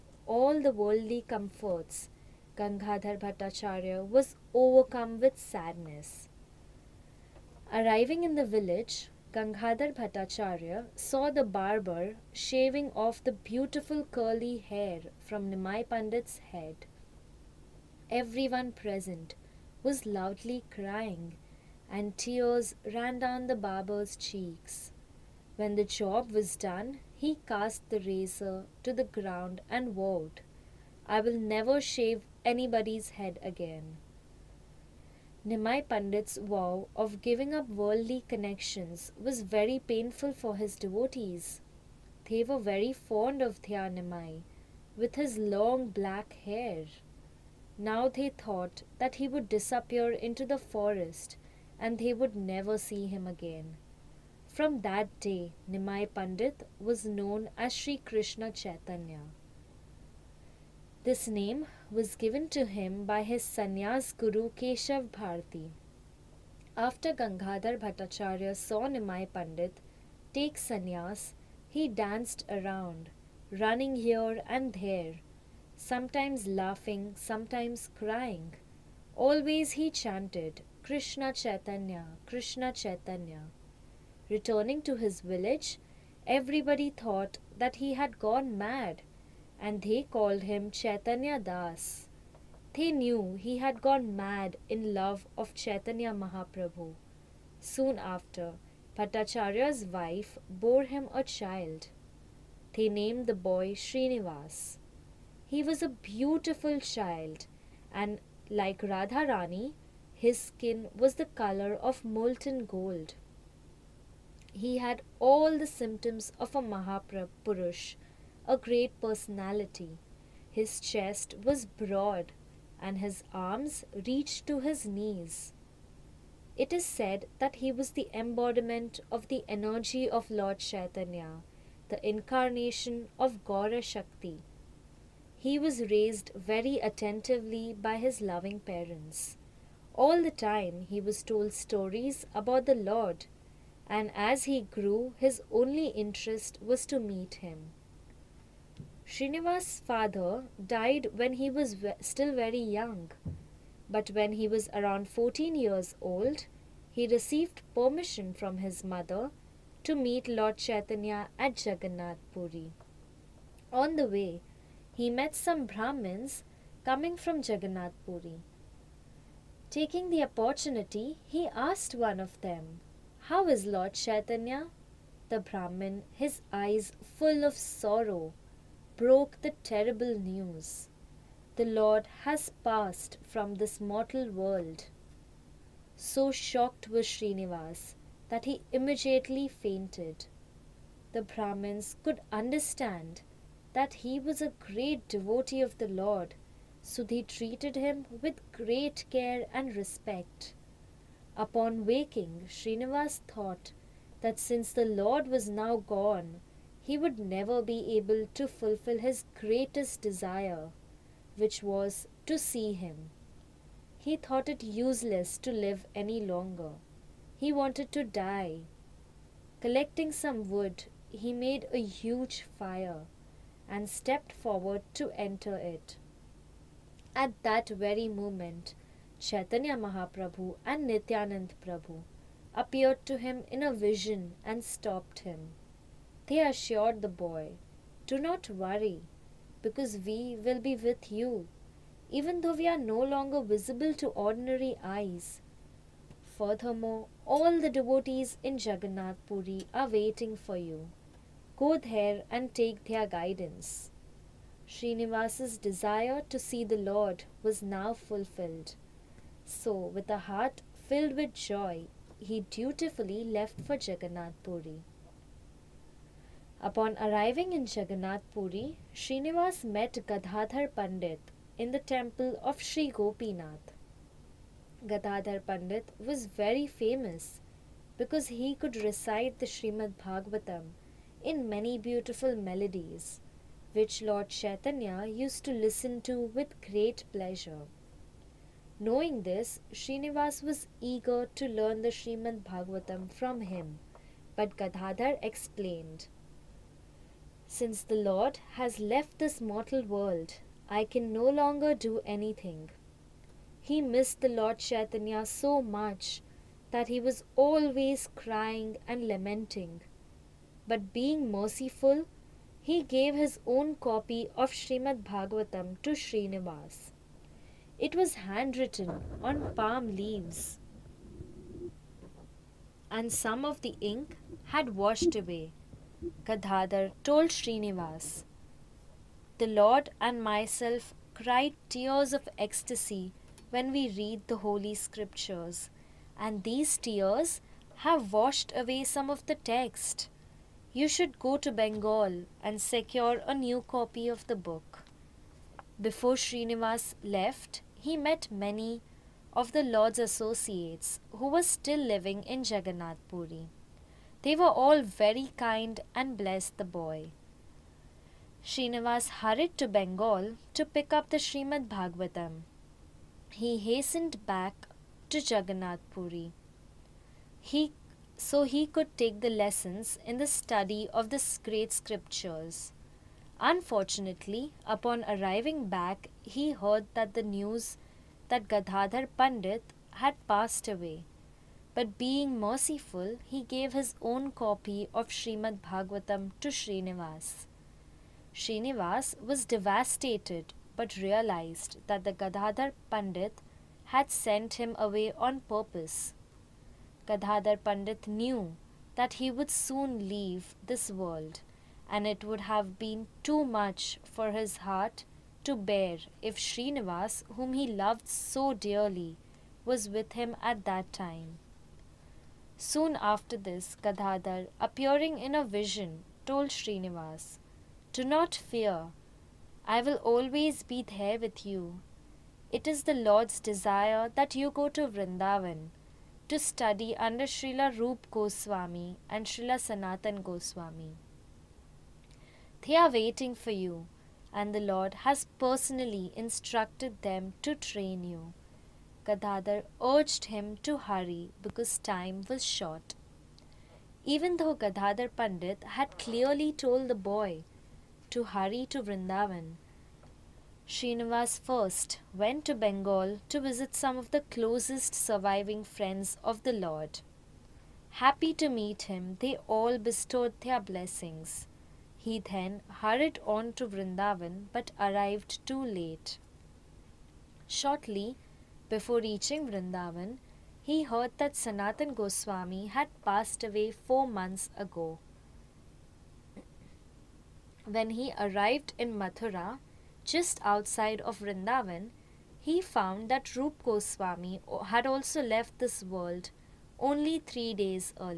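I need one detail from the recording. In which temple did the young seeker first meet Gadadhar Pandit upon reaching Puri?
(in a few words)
Sri Gopinath.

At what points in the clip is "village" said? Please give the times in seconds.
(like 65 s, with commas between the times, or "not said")
8 s, 85 s.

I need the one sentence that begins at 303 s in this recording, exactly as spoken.
He missed the Lord Chaitanya so much that he was always crying and lamenting.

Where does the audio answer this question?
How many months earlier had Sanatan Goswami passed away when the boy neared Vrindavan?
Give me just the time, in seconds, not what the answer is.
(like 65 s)
473 s.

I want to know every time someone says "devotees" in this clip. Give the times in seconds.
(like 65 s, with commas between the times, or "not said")
40 s, 195 s, 247 s.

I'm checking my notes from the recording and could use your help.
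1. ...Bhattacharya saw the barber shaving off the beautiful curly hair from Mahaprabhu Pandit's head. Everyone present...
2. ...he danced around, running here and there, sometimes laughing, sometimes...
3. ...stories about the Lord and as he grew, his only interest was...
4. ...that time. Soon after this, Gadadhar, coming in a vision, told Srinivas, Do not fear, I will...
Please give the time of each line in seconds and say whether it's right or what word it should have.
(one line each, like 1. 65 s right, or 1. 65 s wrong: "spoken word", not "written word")
1. 9 s wrong: "Nimai", not "Mahaprabhu"
2. 71 s right
3. 141 s right
4. 410 s wrong: "appearing", not "coming".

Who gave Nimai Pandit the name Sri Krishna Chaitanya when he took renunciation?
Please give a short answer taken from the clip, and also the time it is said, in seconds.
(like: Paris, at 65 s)
Keshav Bharti, at 64 s.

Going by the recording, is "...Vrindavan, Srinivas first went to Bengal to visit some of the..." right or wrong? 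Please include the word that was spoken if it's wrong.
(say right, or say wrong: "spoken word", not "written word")
right.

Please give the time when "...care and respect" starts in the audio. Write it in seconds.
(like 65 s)
199 s.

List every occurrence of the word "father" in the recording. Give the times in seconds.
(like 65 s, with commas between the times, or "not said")
149 s.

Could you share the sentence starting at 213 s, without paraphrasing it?
He thought it useless to live any longer.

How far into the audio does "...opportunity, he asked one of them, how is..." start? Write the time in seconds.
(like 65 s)
170 s.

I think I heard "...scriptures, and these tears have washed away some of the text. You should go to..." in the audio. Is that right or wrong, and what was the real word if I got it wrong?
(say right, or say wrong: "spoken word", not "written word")
right.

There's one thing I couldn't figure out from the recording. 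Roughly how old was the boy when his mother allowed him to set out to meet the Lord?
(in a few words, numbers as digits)
14.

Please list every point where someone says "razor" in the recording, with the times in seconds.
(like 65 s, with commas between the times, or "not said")
27 s.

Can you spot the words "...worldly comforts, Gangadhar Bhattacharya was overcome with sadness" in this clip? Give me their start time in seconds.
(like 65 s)
0 s.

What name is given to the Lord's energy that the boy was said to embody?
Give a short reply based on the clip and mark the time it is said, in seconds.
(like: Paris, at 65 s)
Gaura Shakti, at 133 s.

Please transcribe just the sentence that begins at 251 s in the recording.
Go there and take their guidance.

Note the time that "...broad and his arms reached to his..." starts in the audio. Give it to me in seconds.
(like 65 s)
121 s.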